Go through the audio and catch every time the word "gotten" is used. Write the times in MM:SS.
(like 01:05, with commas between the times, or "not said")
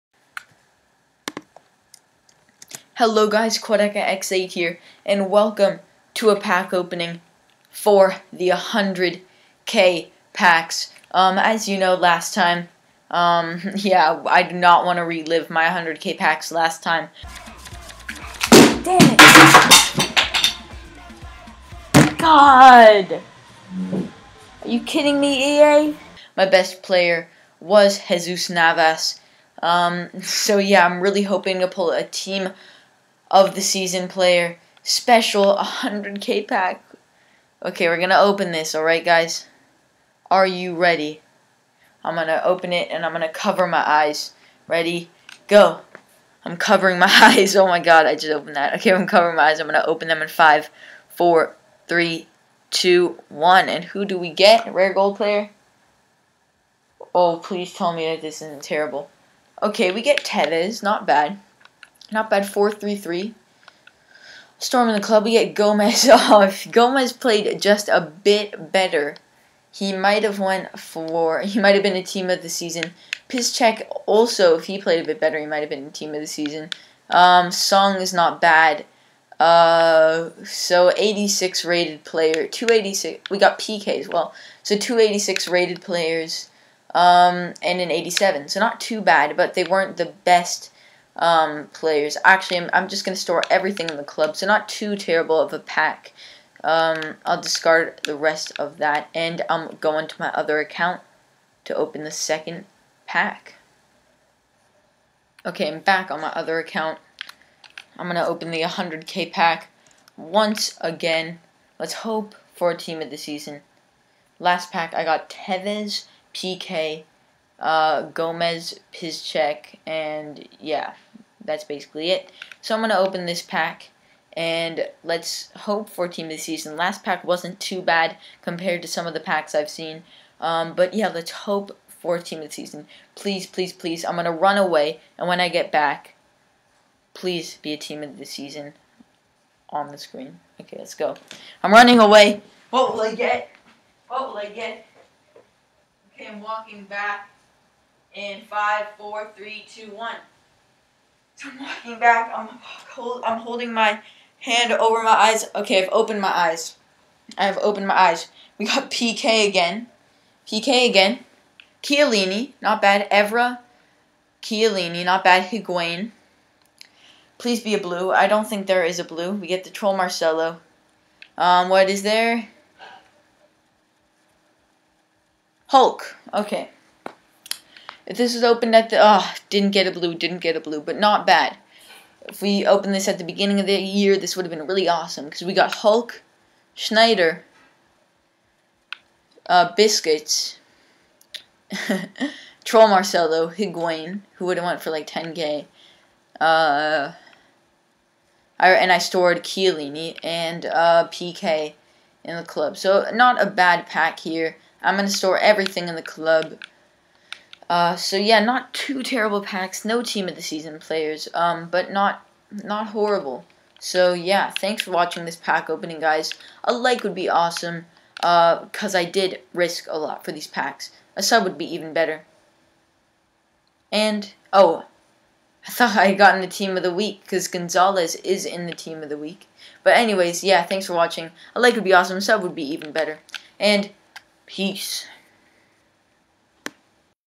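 03:46.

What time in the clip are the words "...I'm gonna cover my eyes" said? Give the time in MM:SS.
00:43.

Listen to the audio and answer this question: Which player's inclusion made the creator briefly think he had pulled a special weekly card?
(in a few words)
Gonzalez.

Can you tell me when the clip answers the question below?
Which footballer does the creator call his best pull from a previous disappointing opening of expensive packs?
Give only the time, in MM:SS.
00:28.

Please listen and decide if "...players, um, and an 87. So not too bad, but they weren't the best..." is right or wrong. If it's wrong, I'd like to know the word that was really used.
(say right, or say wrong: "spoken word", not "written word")
right.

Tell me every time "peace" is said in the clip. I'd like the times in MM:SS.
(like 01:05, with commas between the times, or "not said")
03:54.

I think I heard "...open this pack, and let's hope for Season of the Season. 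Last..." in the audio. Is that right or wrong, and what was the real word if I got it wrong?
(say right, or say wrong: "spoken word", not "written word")
wrong: "Team", not "Season".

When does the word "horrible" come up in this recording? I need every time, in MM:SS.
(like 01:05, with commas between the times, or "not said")
03:32.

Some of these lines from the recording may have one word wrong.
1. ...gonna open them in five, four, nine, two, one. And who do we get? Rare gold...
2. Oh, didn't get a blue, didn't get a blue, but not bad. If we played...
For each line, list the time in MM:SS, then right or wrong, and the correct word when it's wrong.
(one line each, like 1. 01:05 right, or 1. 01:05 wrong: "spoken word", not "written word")
1. 00:49 wrong: "three", not "nine"
2. 02:58 wrong: "opened", not "played".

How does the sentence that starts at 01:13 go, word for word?
Piszczek also, if he played a bit better, he might have been a team of the season.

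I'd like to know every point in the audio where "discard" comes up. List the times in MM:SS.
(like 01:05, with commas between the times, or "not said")
01:37.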